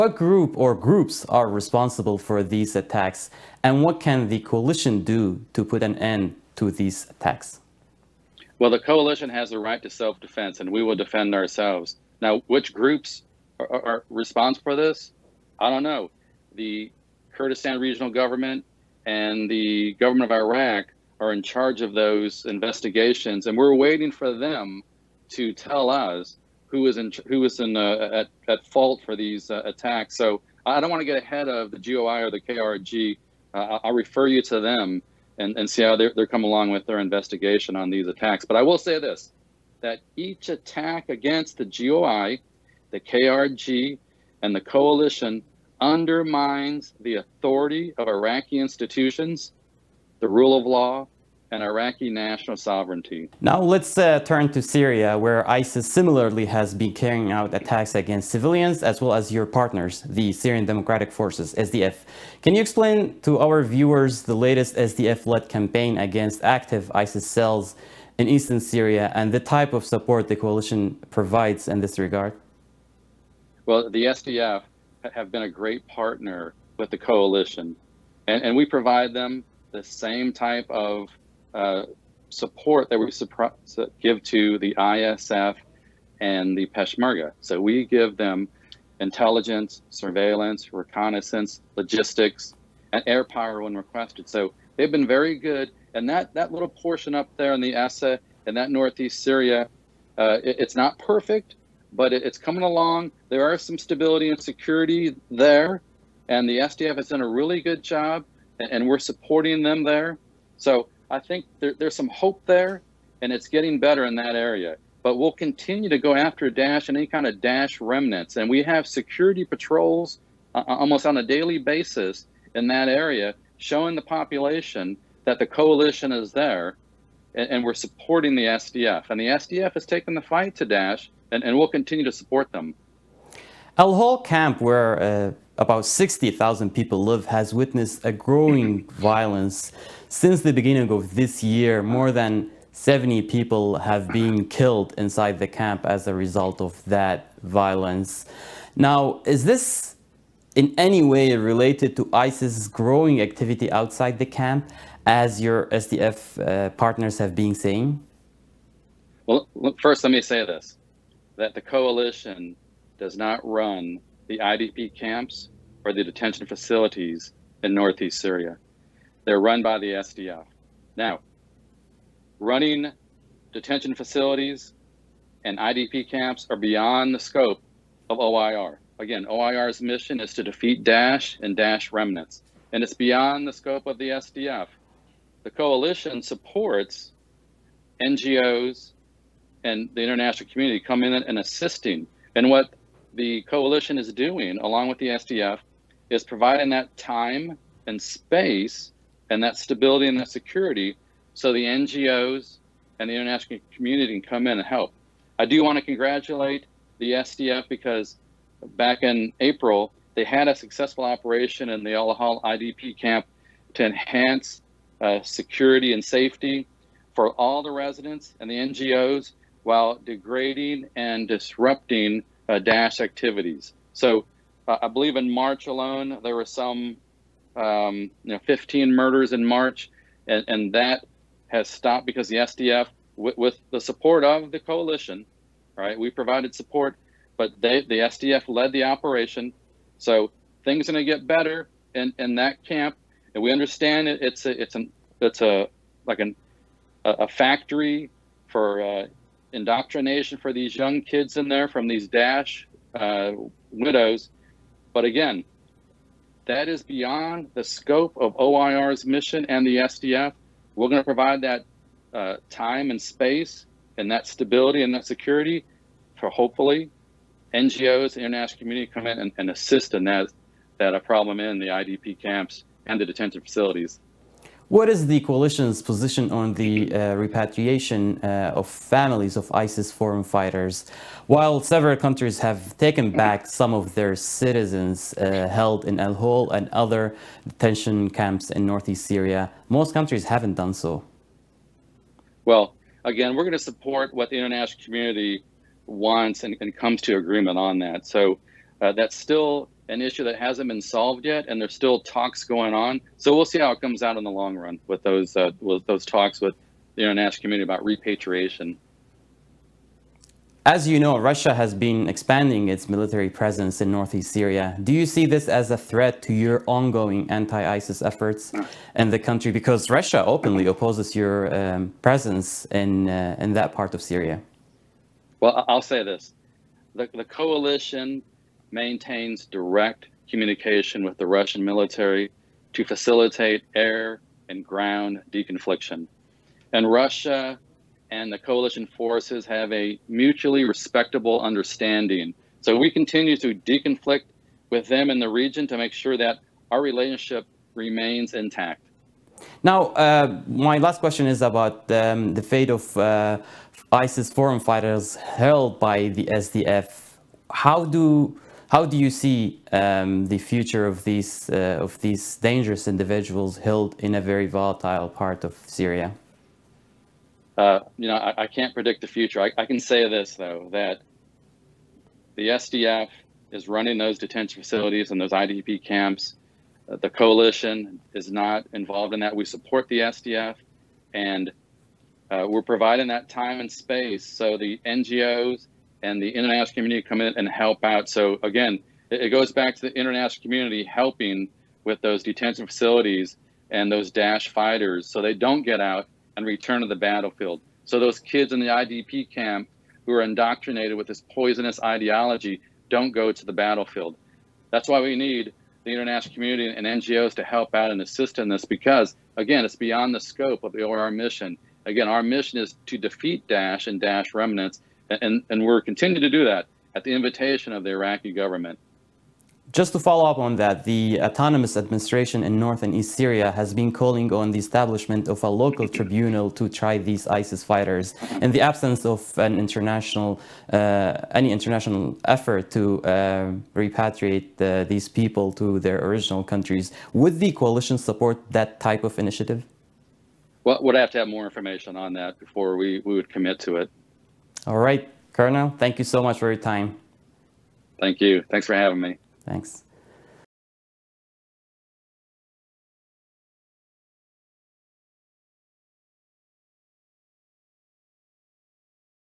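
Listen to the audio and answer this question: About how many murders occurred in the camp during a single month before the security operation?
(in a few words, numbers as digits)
15.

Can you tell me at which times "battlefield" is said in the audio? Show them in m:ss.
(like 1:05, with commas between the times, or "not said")
6:36, 6:43.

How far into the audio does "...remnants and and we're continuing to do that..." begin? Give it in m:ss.
6:54.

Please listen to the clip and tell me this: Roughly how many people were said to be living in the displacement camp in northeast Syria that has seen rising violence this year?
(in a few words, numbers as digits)
60,000.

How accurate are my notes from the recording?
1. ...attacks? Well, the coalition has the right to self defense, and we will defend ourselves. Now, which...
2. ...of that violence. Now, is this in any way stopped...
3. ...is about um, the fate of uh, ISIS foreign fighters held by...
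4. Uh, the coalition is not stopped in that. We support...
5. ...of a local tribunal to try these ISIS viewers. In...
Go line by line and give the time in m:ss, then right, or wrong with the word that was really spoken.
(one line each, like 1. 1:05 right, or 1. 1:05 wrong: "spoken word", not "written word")
1. 0:07 right
2. 2:26 wrong: "related", not "stopped"
3. 5:51 right
4. 6:16 wrong: "involved", not "stopped"
5. 7:05 wrong: "fighters", not "viewers".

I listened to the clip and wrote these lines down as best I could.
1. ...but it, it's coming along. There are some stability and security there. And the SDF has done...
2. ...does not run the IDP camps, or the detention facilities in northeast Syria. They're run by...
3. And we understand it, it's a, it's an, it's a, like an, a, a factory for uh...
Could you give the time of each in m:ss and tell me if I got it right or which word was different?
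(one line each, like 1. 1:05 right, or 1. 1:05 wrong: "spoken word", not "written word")
1. 1:41 right
2. 2:42 right
3. 4:03 right.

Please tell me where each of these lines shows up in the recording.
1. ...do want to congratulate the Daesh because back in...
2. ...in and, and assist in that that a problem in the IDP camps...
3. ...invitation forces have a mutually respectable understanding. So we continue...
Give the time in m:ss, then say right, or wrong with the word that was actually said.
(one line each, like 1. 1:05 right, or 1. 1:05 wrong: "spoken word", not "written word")
1. 3:25 wrong: "SDF", not "Daesh"
2. 4:29 right
3. 5:38 wrong: "coalition", not "invitation".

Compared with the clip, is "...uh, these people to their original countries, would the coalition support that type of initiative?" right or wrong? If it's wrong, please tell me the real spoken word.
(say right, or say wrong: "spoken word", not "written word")
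right.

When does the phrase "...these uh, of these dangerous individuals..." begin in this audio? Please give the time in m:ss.
6:01.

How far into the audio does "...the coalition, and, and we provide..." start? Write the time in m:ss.
1:16.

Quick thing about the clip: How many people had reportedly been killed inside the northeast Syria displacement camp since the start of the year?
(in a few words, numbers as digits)
More than 70.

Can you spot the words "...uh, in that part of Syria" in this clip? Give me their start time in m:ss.
5:23.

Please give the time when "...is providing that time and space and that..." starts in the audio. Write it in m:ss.
3:16.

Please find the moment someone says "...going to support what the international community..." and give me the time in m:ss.
4:53.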